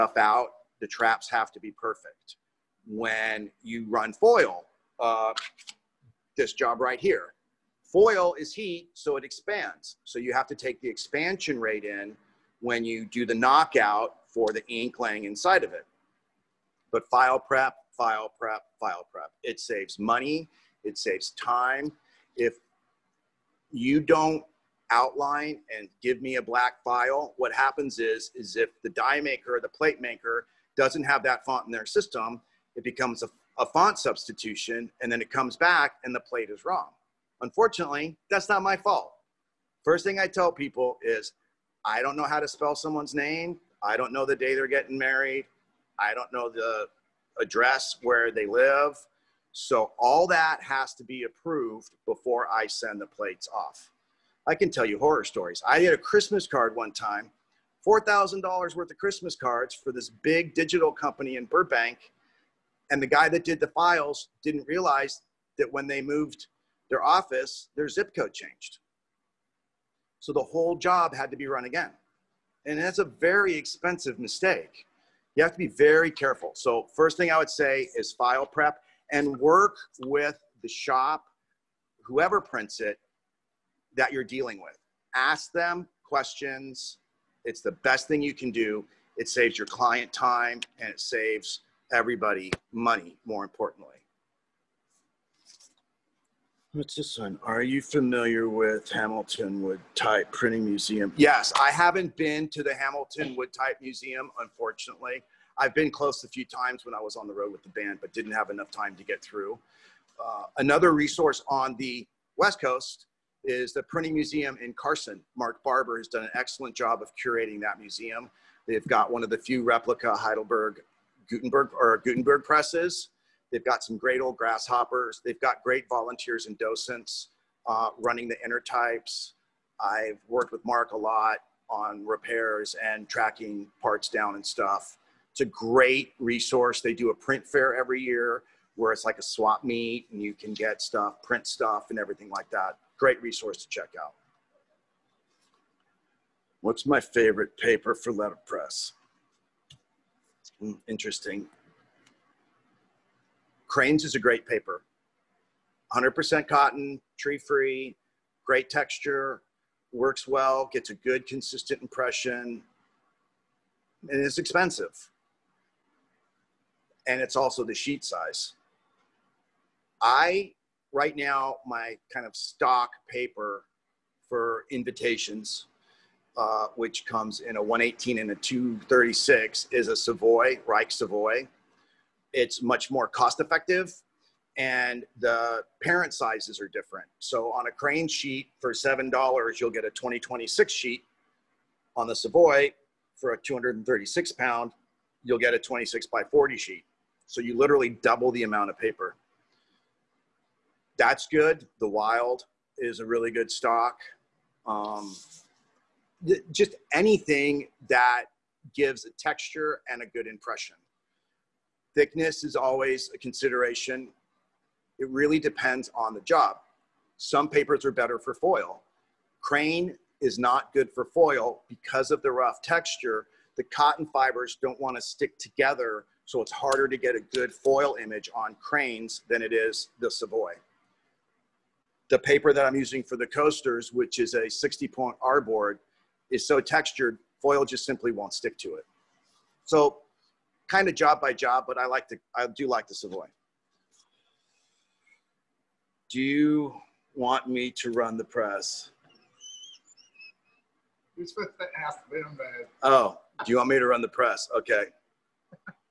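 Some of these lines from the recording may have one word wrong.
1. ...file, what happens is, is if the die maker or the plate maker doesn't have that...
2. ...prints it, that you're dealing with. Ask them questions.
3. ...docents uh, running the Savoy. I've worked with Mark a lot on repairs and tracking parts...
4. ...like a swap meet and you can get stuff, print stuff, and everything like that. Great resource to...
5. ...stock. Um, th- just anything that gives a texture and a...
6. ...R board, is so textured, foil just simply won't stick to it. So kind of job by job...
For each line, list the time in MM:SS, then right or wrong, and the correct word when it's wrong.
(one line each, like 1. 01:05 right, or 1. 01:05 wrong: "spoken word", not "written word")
1. 00:26 right
2. 01:22 right
3. 02:06 wrong: "Intertypes", not "Savoy"
4. 02:19 right
5. 03:23 right
6. 03:55 right.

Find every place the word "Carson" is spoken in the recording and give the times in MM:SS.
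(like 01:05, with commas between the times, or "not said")
01:54.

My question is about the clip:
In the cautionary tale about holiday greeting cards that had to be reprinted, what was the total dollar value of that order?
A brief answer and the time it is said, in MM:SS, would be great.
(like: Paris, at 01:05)
$4,000, at 00:57.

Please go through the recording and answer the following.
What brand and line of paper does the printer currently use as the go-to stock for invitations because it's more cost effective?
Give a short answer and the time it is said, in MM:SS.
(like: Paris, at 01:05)
Reich Savoy, at 03:00.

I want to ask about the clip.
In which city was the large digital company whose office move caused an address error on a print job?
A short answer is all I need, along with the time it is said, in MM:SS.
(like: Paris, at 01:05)
Burbank, at 01:01.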